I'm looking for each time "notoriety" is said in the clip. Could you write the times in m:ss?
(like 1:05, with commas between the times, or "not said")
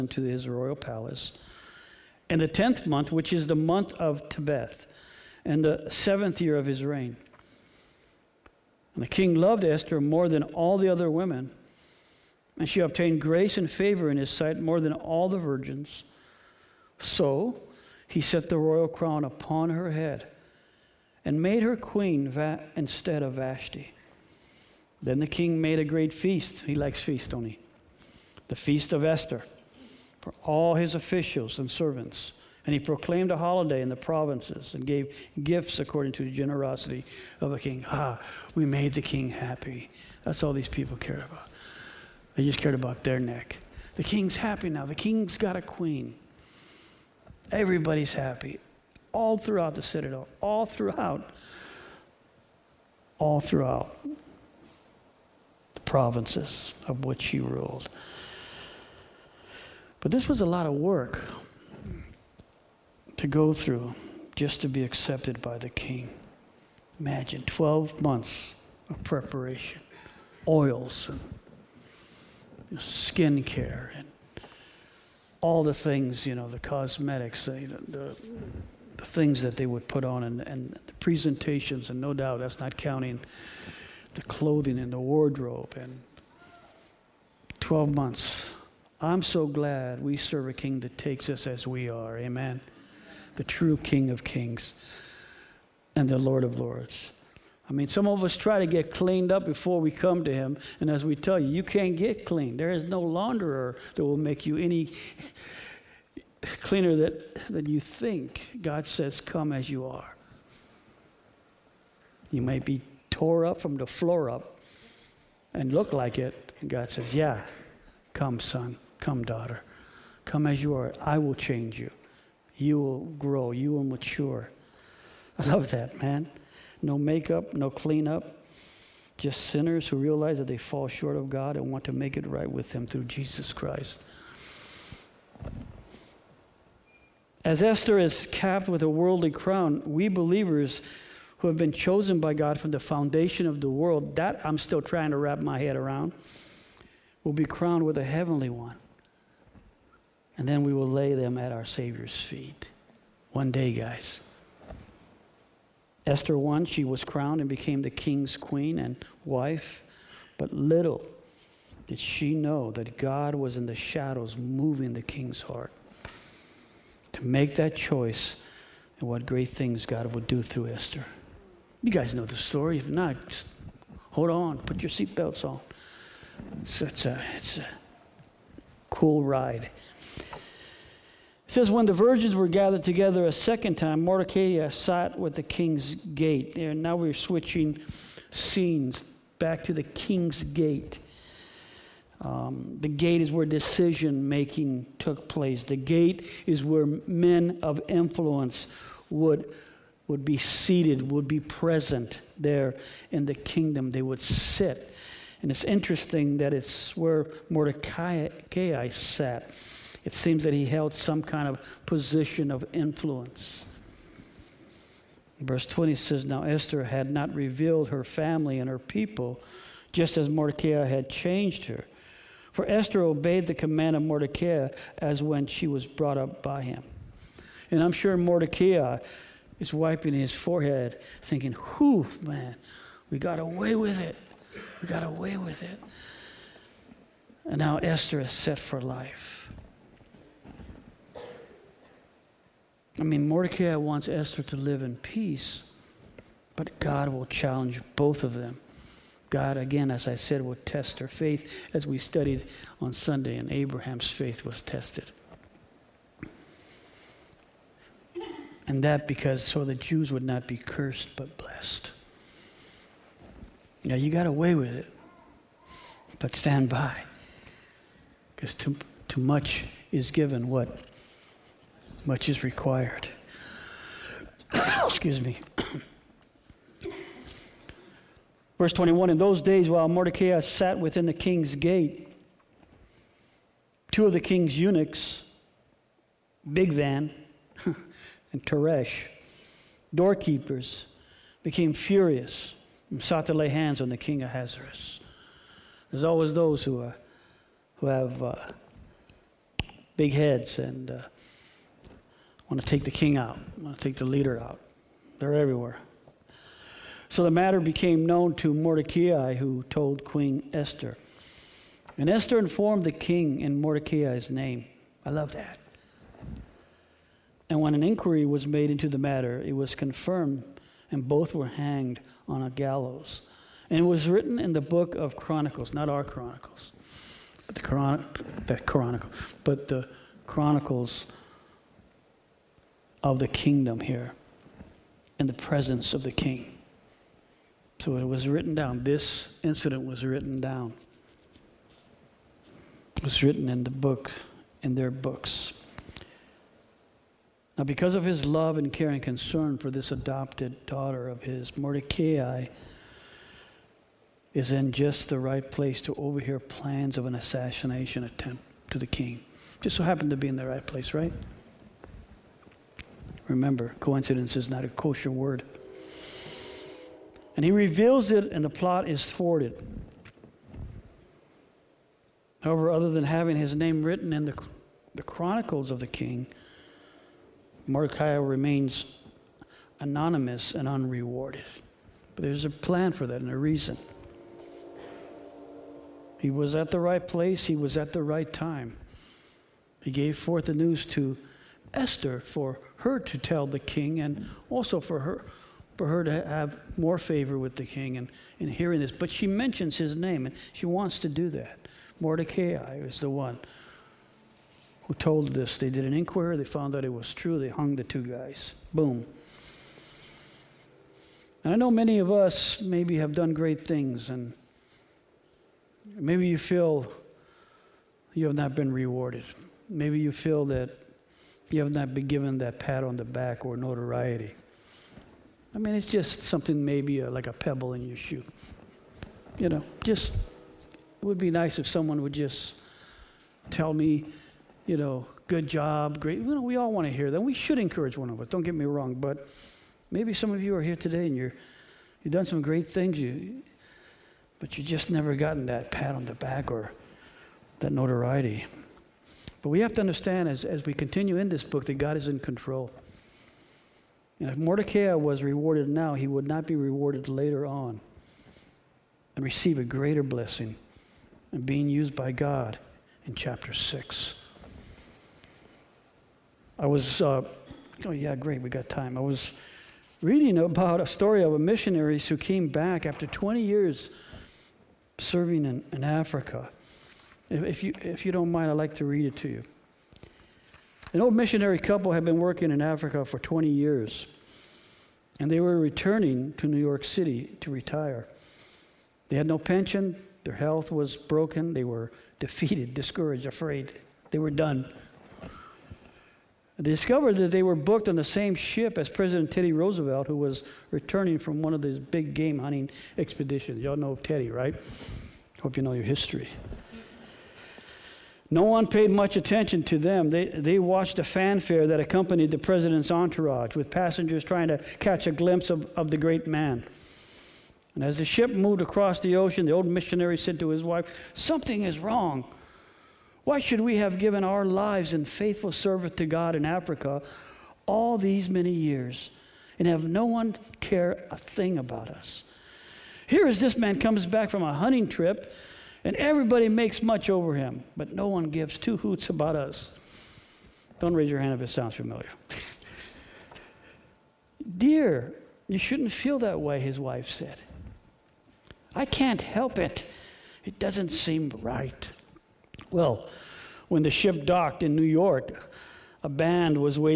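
7:03, 7:27.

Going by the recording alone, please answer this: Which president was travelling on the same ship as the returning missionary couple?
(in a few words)
Teddy Roosevelt.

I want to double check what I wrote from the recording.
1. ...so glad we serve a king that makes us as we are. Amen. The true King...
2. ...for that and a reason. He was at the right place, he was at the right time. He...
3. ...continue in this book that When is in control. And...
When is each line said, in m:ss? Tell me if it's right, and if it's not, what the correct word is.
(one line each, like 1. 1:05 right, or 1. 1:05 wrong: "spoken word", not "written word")
1. 1:29 wrong: "takes", not "makes"
2. 6:22 right
3. 7:30 wrong: "God", not "When".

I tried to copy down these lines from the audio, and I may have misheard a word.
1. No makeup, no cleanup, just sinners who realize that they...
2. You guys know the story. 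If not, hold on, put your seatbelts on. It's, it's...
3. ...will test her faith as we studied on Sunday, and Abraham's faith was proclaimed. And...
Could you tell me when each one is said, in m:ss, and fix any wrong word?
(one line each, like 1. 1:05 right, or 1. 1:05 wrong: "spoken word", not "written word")
1. 2:06 right
2. 2:51 right
3. 4:10 wrong: "tested", not "proclaimed".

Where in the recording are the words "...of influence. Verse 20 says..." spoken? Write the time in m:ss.
3:32.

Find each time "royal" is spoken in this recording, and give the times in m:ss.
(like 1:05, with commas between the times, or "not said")
0:00, 0:18.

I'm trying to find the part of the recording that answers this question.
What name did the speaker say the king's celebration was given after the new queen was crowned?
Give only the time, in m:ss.
0:28.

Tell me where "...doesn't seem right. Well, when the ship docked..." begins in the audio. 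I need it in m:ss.
9:10.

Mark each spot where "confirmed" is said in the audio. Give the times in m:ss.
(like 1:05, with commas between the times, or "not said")
5:19.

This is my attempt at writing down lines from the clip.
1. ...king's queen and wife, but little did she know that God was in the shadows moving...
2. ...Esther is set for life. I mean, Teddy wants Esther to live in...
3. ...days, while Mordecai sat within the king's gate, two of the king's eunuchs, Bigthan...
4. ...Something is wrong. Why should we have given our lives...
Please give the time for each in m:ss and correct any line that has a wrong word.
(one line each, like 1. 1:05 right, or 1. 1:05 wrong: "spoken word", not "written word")
1. 2:37 right
2. 3:57 wrong: "Mordecai", not "Teddy"
3. 4:39 right
4. 8:41 right.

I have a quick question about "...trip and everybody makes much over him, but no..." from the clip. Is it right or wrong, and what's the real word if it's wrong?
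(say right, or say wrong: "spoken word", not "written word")
right.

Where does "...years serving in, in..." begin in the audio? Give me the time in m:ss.
7:53.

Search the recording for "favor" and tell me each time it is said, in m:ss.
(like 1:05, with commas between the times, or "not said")
0:13, 6:36.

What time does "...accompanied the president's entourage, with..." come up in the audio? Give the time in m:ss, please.
8:31.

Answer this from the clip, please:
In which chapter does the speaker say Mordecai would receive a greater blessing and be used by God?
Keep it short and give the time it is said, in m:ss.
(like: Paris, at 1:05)
Chapter 6, at 7:43.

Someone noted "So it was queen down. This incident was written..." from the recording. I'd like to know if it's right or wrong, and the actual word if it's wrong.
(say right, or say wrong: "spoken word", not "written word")
wrong: "written", not "queen".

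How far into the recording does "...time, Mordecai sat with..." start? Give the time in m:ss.
3:03.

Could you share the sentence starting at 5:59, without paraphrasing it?
Just so happened to be in the right place, right?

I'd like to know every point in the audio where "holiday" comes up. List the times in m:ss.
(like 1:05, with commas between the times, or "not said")
0:33.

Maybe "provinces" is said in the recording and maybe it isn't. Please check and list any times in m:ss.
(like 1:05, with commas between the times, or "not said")
0:33, 0:55.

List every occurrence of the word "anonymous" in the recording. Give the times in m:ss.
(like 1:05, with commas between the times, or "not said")
6:19.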